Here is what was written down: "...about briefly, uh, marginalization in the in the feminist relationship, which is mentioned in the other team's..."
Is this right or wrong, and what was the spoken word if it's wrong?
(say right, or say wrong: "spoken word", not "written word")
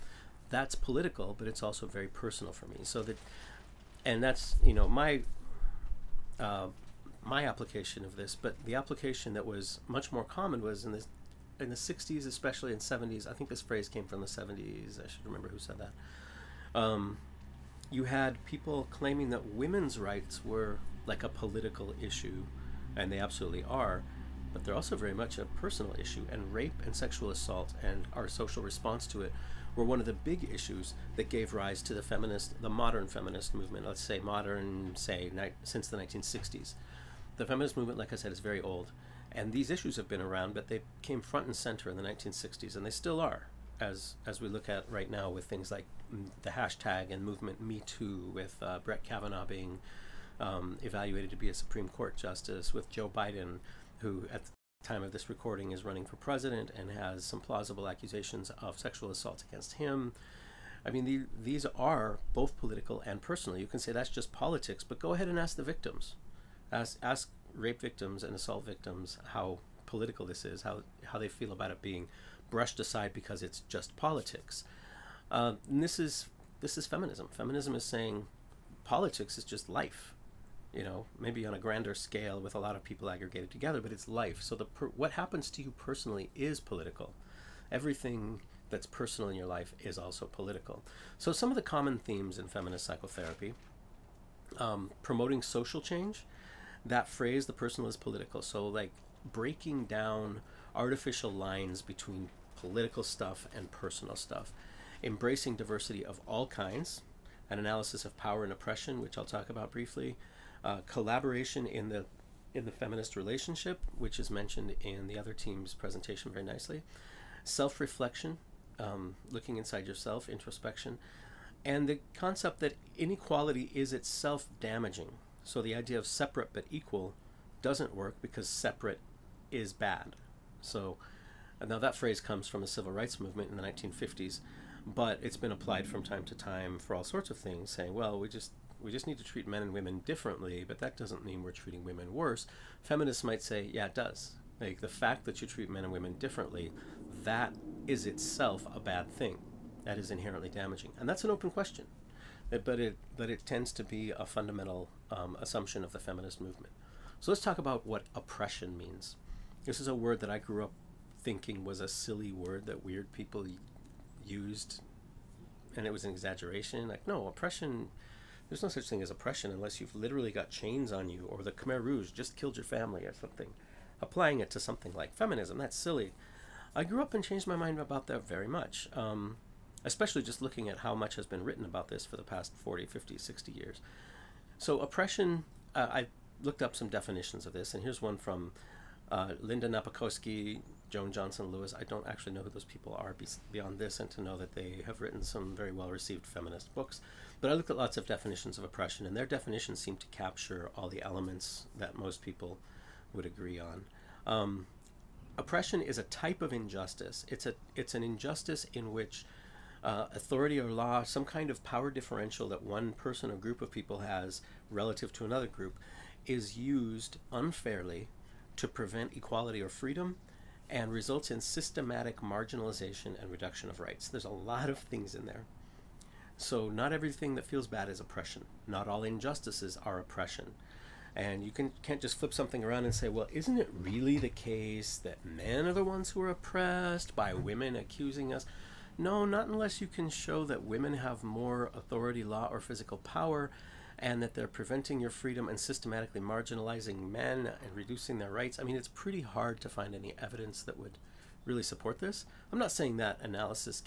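wrong: "collaboration", not "marginalization".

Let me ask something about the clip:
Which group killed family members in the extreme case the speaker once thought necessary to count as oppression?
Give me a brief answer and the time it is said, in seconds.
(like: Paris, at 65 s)
Khmer Rouge, at 171 s.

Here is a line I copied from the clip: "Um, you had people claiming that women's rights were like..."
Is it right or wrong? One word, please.
right.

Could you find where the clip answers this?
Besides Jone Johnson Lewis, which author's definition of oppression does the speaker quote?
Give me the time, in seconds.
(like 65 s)
189 s.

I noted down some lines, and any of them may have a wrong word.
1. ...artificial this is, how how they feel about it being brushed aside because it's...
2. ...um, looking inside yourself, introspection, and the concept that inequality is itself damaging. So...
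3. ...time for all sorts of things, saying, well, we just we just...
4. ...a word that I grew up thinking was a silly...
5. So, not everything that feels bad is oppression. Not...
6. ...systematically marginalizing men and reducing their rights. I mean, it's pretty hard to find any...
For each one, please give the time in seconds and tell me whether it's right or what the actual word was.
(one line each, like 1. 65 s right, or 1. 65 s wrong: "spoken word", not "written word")
1. 69 s wrong: "political", not "artificial"
2. 118 s right
3. 136 s right
4. 159 s right
5. 226 s right
6. 245 s right.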